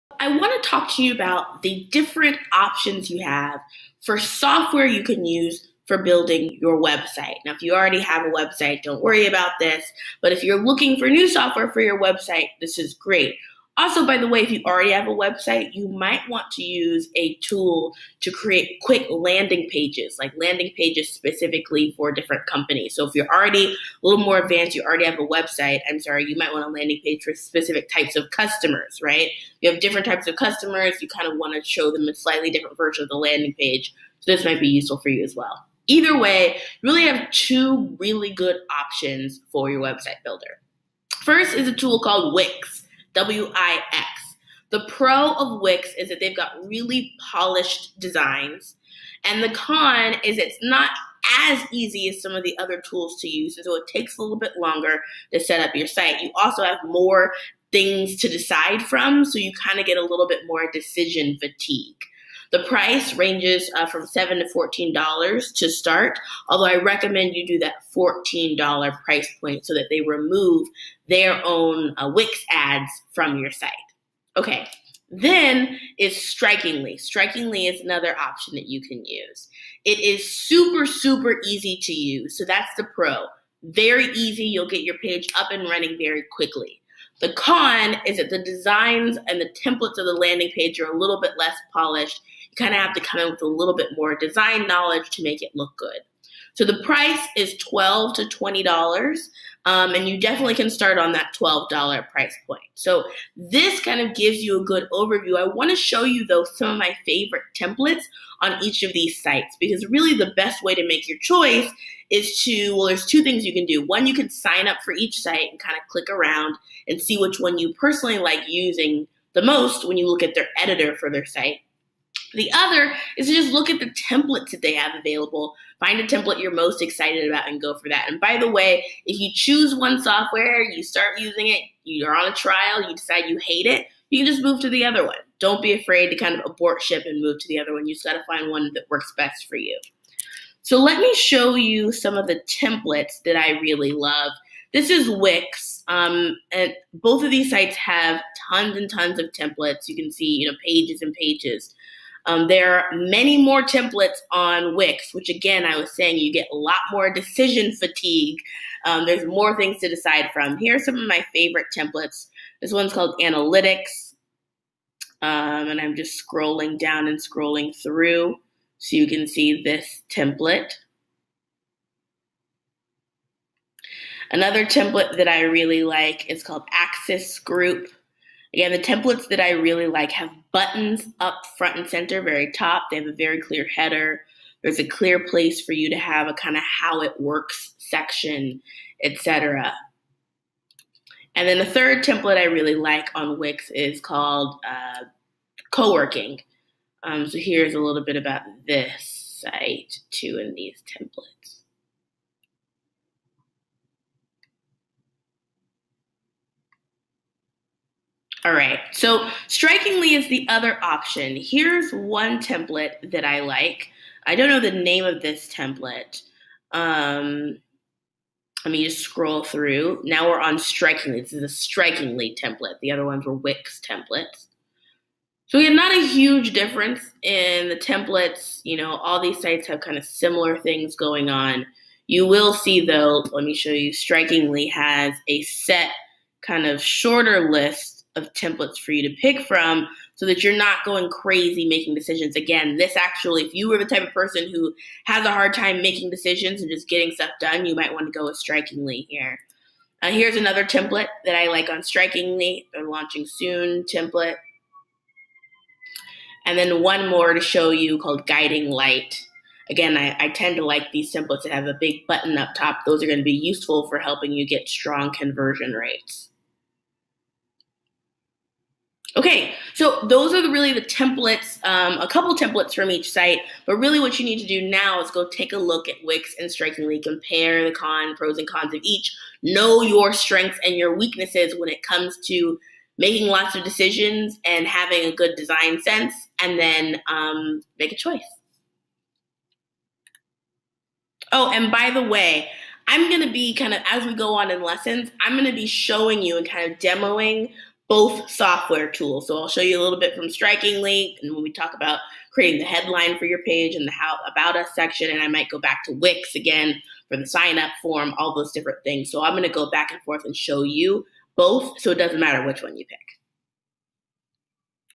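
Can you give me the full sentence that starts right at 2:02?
The other is to just look at the templates that they have available.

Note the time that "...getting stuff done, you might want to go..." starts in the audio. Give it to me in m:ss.
4:06.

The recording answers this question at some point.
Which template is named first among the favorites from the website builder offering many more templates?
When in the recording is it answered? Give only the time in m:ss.
2:43.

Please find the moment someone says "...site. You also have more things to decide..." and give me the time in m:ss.
0:55.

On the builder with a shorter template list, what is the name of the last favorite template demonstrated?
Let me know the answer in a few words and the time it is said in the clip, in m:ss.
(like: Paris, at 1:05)
Guiding Light, at 4:18.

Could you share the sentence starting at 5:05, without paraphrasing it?
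And I might go back to Wix again for the sign up form, all those different things.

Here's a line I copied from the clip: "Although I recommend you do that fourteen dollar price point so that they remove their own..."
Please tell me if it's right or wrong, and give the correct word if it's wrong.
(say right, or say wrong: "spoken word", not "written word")
right.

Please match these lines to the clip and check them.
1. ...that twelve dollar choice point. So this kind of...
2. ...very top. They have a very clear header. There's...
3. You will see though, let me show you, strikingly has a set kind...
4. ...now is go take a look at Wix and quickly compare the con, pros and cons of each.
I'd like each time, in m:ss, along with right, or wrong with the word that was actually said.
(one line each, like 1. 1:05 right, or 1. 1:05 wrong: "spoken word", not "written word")
1. 1:41 wrong: "price", not "choice"
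2. 3:02 right
3. 3:52 right
4. 4:34 wrong: "strikingly", not "quickly".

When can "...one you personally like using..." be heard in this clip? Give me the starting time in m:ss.
1:57.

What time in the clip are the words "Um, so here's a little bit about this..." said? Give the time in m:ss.
3:17.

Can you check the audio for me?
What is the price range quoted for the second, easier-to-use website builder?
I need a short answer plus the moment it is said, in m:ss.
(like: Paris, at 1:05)
$12 to $20, at 1:37.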